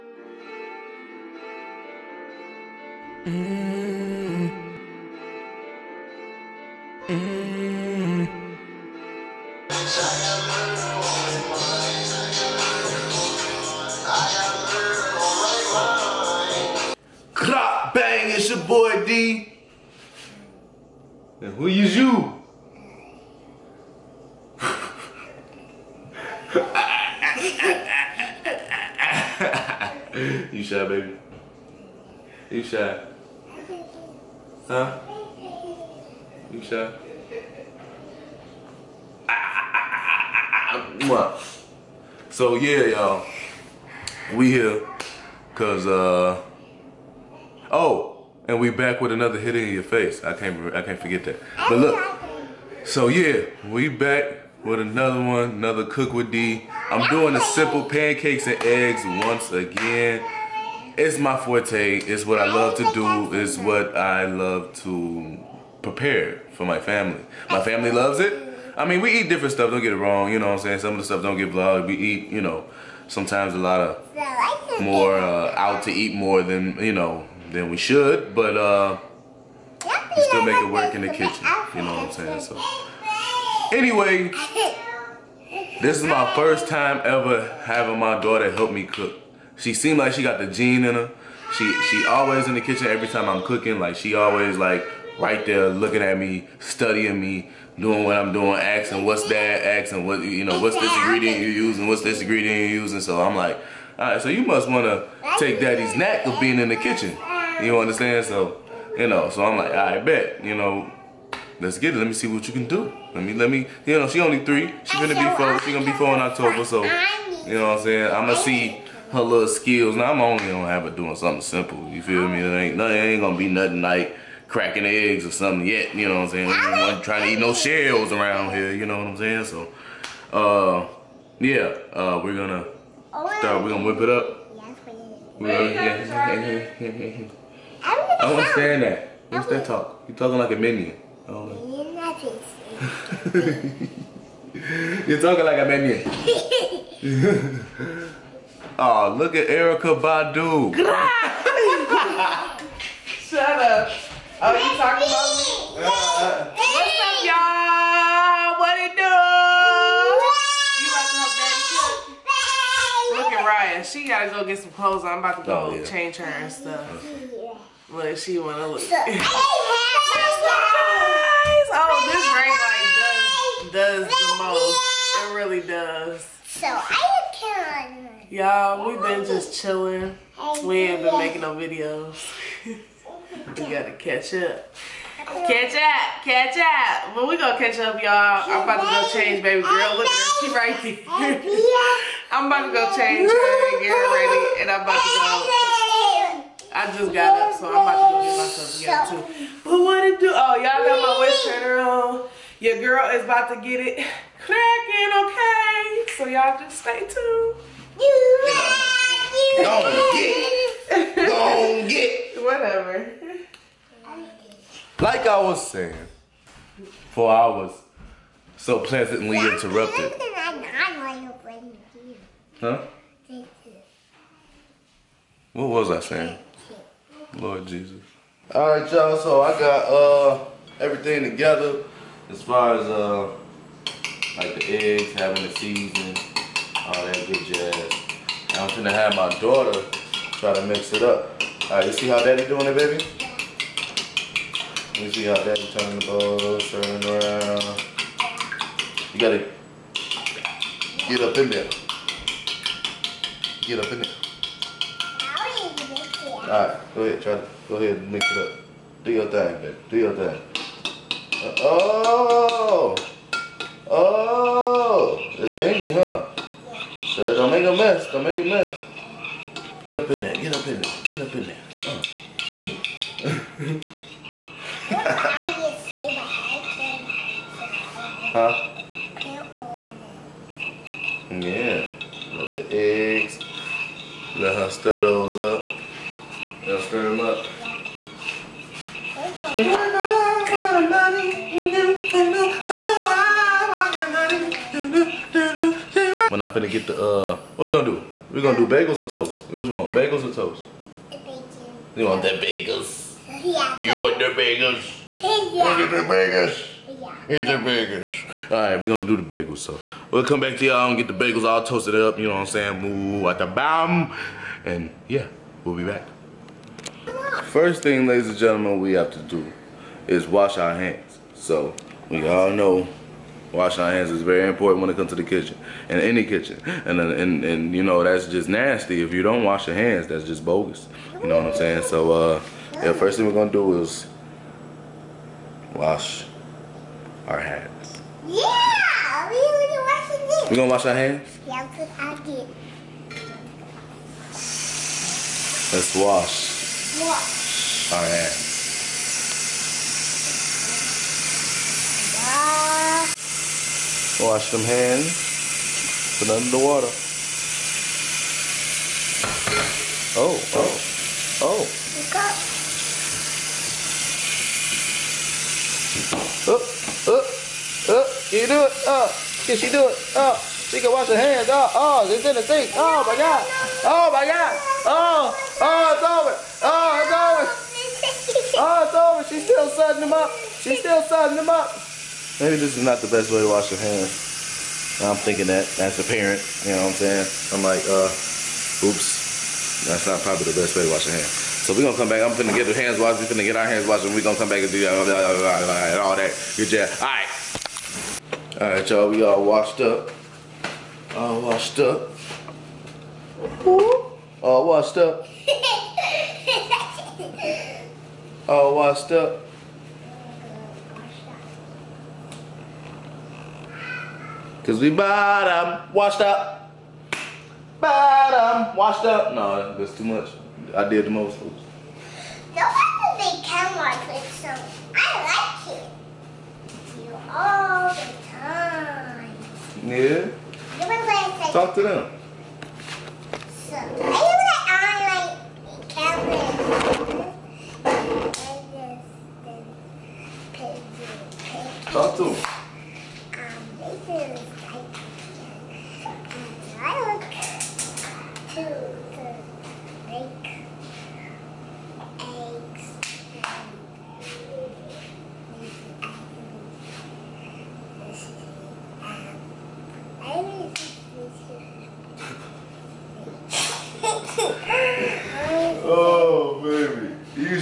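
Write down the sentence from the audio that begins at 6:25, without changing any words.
I'm thinking that as a parent, you know what I'm saying?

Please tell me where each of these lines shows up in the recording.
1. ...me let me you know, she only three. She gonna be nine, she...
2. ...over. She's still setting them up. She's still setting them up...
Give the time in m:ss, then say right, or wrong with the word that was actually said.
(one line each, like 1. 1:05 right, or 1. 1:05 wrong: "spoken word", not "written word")
1. 1:53 wrong: "four", not "nine"
2. 6:18 right.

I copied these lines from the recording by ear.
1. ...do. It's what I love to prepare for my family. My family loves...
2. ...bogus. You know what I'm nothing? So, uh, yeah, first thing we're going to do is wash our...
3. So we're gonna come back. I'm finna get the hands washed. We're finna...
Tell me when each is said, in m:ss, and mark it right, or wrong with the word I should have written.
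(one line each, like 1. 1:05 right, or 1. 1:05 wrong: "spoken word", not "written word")
1. 1:02 right
2. 5:30 wrong: "saying", not "nothing"
3. 6:31 right.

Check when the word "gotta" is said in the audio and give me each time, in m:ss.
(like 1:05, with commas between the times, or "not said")
2:44, 3:03, 4:09.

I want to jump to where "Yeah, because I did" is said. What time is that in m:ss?
5:41.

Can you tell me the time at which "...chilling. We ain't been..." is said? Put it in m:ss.
2:59.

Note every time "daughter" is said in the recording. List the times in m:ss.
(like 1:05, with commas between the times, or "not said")
1:28, 3:59.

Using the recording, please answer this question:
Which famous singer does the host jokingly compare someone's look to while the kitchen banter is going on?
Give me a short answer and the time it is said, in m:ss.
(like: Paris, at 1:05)
Erykah Badu, at 2:29.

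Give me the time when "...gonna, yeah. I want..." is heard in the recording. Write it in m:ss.
2:15.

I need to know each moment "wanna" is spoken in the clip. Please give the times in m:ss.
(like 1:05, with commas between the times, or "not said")
1:44, 2:48.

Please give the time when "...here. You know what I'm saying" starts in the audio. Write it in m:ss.
2:08.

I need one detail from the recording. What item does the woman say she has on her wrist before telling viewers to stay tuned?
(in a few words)
Wrist trainer.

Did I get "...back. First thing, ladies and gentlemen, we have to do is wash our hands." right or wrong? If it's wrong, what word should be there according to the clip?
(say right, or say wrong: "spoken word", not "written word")
right.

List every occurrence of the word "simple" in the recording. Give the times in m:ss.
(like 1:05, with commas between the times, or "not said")
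0:57, 2:01.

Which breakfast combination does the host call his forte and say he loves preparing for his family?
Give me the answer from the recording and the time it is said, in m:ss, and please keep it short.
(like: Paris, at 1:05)
Pancakes and eggs, at 0:57.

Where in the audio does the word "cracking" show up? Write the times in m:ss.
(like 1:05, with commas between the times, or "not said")
2:04, 3:24.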